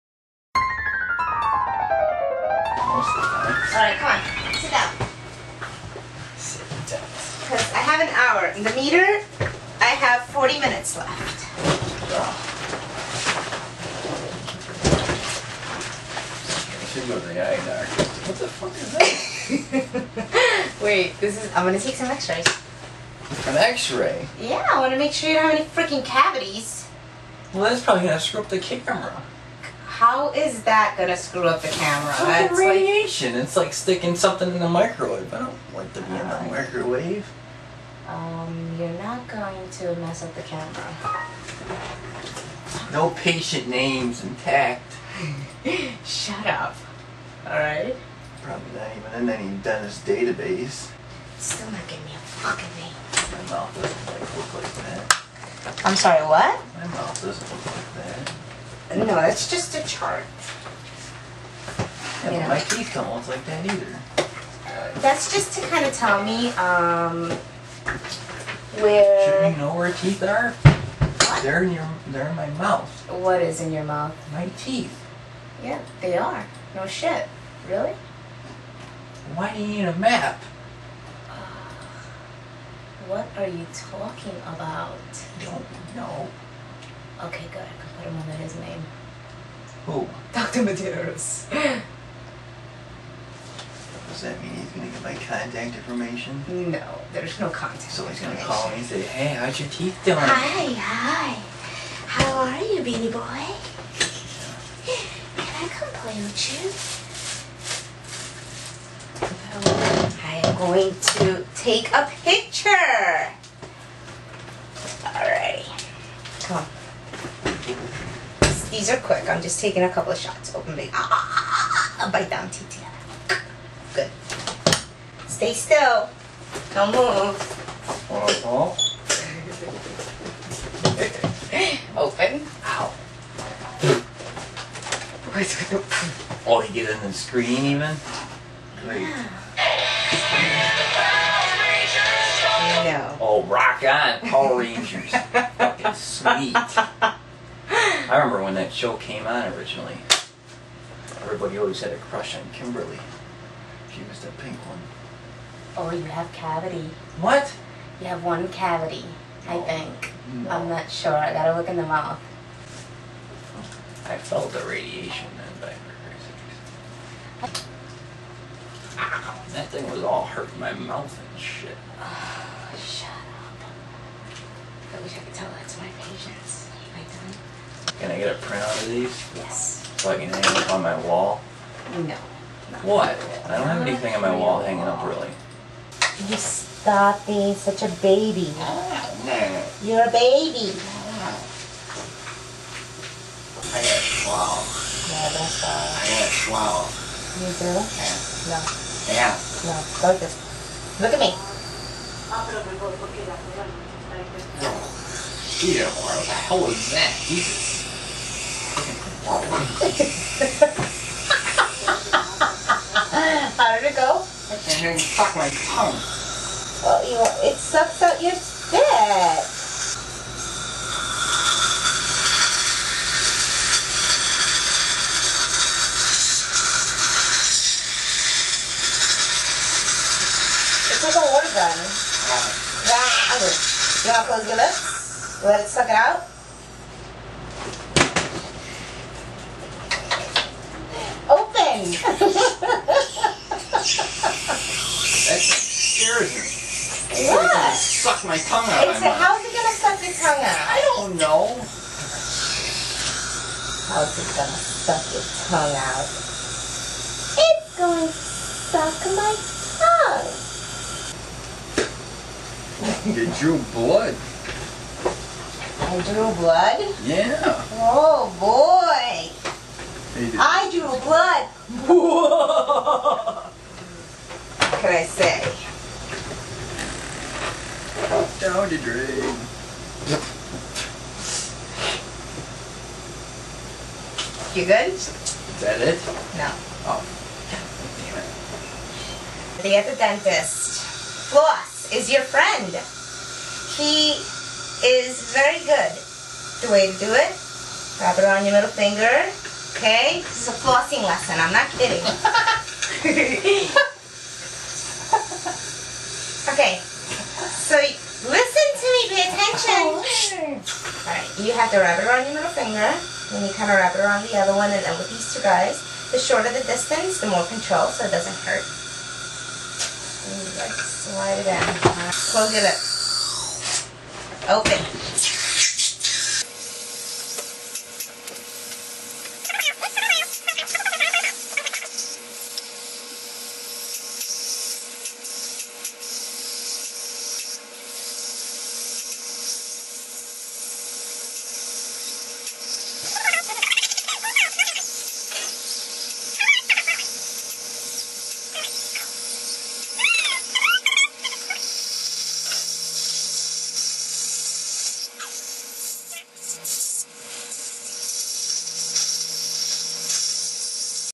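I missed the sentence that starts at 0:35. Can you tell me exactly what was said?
I don't want to be in the microwave.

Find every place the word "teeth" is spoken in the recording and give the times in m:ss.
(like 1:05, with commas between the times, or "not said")
1:02, 1:09, 1:14, 1:39, 2:02.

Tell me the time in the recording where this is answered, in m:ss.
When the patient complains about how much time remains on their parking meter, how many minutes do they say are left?
0:10.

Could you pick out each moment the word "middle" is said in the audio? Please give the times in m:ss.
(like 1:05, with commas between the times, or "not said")
4:58, 5:12.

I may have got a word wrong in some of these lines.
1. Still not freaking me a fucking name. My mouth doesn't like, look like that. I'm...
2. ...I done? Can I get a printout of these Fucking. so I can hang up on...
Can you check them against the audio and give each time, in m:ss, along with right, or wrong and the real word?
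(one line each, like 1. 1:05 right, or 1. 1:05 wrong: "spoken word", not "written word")
1. 0:51 wrong: "giving", not "freaking"
2. 2:56 wrong: "Yes", not "Fucking".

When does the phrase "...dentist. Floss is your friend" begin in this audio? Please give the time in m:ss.
4:49.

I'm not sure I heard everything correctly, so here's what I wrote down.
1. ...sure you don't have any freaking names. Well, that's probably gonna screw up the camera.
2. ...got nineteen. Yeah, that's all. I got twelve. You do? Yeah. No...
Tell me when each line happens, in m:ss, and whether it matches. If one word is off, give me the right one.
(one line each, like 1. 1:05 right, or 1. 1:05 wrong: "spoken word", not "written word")
1. 0:25 wrong: "cavities", not "names"
2. 3:13 wrong: "twelve", not "nineteen".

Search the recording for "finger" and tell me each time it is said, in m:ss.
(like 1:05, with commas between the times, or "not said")
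4:58, 5:12.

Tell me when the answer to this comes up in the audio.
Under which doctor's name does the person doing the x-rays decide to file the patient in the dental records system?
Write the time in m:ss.
1:30.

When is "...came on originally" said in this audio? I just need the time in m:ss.
2:28.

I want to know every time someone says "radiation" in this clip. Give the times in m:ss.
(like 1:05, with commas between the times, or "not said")
0:32, 2:44.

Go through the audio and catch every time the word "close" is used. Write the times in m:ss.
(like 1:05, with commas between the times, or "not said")
3:54, 5:22.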